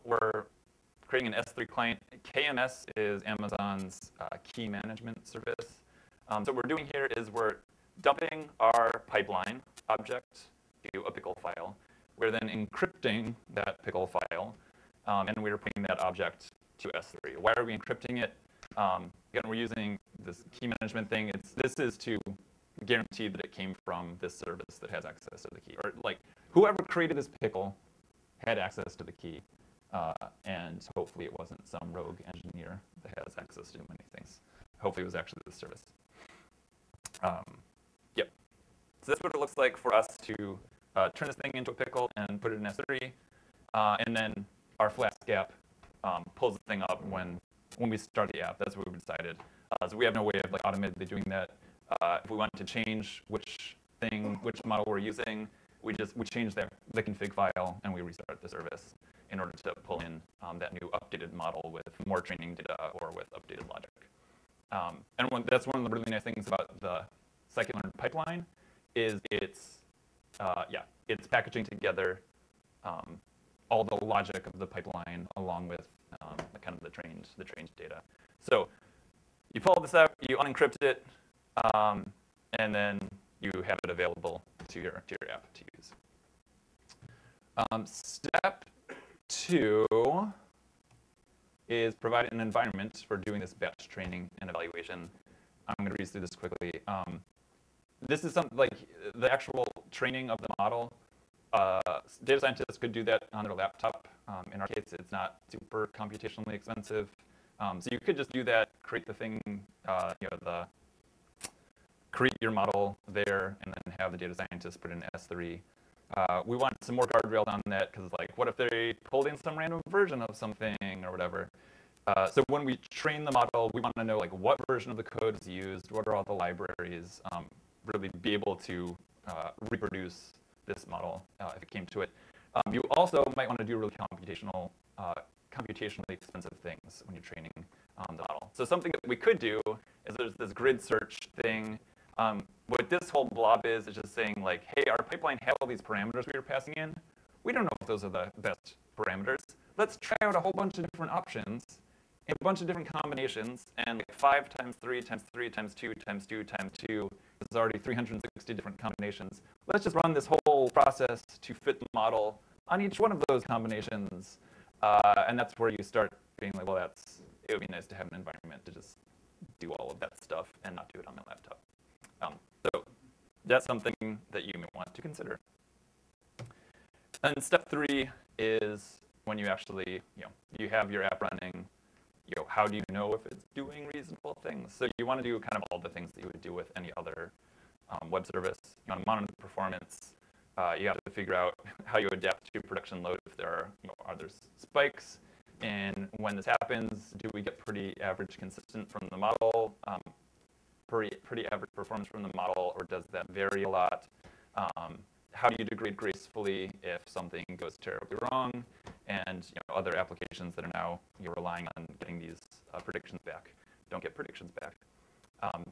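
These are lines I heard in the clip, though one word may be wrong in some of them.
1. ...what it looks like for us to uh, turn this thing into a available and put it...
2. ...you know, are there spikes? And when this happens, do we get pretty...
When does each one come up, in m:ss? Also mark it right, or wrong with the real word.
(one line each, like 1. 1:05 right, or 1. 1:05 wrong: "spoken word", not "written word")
1. 0:39 wrong: "pickle", not "available"
2. 3:13 right.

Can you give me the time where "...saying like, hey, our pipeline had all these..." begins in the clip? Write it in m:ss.
2:24.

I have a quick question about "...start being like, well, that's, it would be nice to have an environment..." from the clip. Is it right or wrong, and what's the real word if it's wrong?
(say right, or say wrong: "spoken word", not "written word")
right.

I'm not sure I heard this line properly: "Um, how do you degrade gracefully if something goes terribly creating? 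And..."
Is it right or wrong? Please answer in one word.
wrong.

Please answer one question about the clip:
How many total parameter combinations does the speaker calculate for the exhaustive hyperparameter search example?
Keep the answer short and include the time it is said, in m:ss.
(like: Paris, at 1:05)
360, at 2:37.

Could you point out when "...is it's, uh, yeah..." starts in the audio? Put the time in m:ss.
1:08.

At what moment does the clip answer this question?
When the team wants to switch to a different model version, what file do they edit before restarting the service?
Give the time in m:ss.
0:57.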